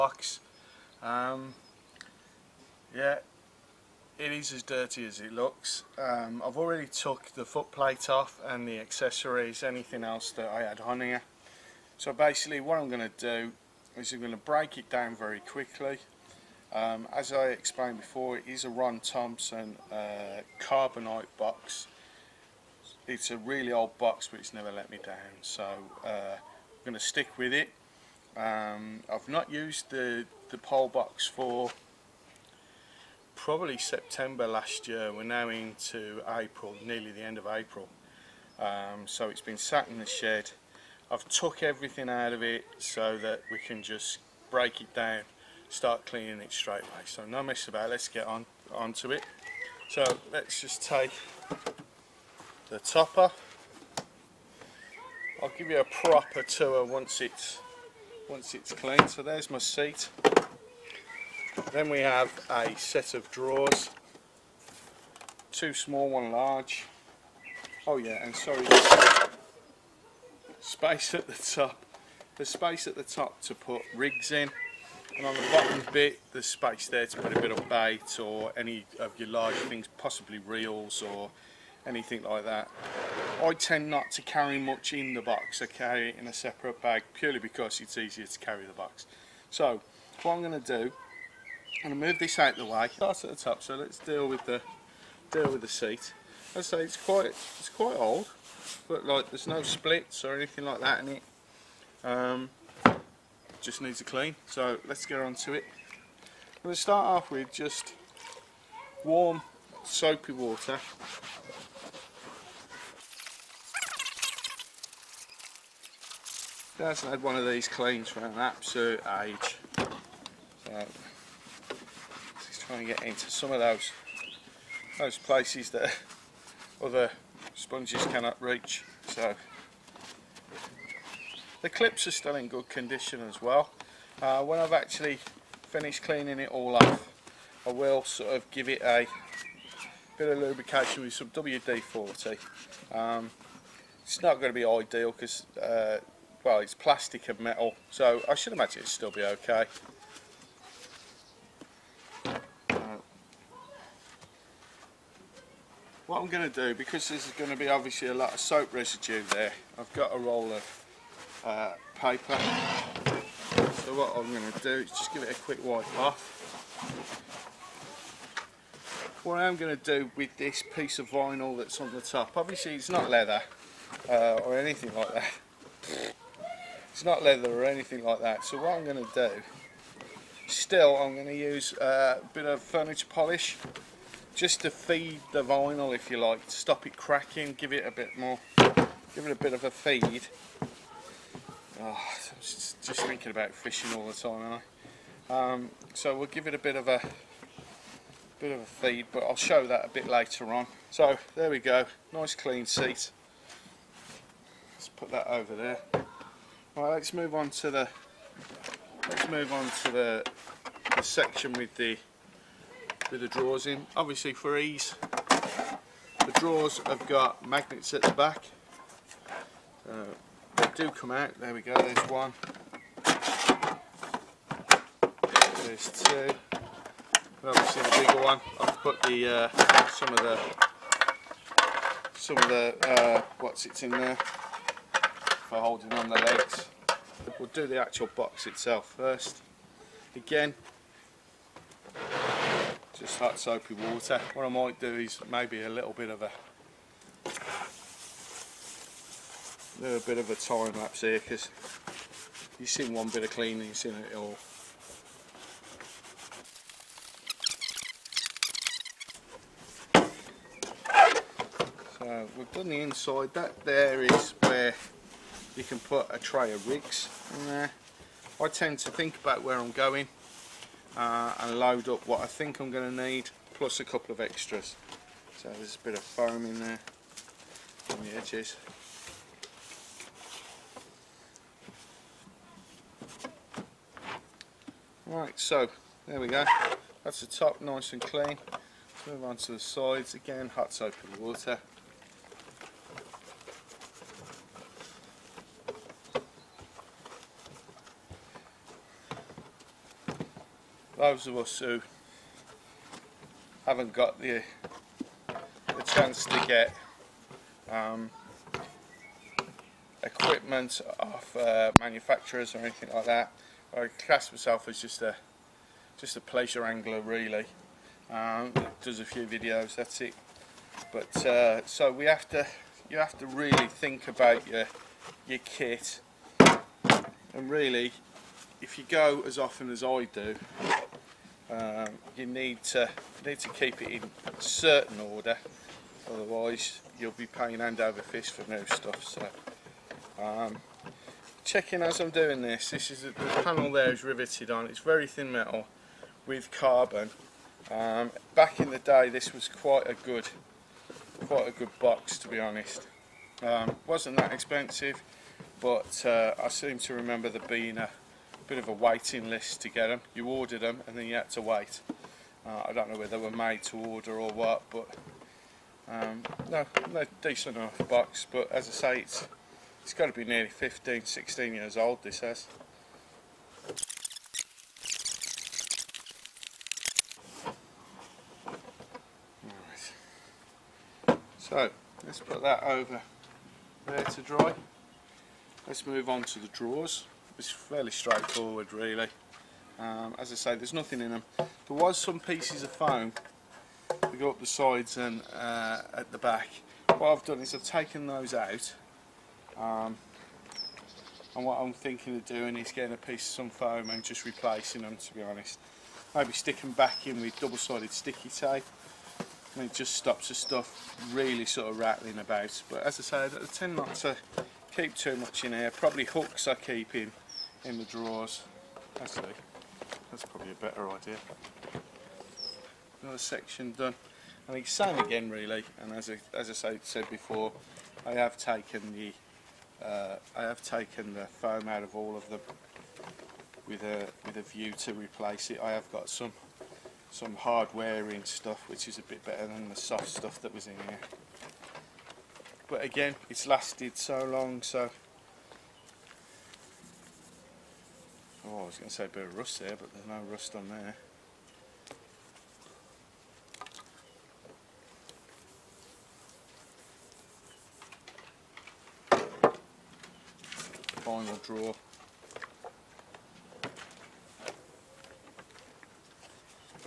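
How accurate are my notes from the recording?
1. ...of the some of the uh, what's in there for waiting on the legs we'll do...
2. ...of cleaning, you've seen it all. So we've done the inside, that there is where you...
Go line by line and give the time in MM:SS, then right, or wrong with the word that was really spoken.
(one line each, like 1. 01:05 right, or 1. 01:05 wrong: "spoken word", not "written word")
1. 03:50 wrong: "holding", not "waiting"
2. 04:13 right.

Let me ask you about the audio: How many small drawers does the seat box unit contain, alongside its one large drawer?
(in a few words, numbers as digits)
2.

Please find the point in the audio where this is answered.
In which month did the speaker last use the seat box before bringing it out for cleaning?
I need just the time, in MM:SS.
00:33.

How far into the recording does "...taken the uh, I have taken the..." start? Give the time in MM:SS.
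07:08.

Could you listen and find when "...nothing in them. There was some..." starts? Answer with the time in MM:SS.
06:30.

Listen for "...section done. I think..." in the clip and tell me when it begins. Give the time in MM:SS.
07:03.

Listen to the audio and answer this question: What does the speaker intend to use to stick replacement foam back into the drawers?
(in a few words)
double-sided sticky tape.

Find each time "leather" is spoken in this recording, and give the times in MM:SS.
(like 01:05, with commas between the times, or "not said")
02:53, 02:57.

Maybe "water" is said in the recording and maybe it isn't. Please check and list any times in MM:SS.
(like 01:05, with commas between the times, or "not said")
01:50, 04:03, 04:51.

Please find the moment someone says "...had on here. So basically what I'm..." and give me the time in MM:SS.
00:10.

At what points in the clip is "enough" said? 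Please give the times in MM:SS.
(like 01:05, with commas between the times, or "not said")
06:07.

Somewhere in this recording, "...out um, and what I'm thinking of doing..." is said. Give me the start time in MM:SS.
06:38.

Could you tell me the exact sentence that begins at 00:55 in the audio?
I'll give you a proper tour once it's once it's clean.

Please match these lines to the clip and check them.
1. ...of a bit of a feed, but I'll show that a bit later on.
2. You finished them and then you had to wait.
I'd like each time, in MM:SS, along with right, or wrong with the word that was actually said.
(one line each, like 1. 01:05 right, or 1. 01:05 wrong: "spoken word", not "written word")
1. 03:16 right
2. 06:00 wrong: "ordered", not "finished".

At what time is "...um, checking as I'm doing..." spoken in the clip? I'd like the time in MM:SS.
05:40.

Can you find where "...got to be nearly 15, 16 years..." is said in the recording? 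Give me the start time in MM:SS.
06:09.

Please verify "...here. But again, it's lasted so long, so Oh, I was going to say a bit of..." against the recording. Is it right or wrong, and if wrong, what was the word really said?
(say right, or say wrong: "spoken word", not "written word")
right.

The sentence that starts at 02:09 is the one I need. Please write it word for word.
So the clips are still in good condition as well.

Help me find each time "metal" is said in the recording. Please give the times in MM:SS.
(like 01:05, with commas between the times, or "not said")
02:27, 05:45.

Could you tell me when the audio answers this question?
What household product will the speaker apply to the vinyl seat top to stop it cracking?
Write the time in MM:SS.
03:02.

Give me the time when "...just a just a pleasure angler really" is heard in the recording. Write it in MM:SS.
05:14.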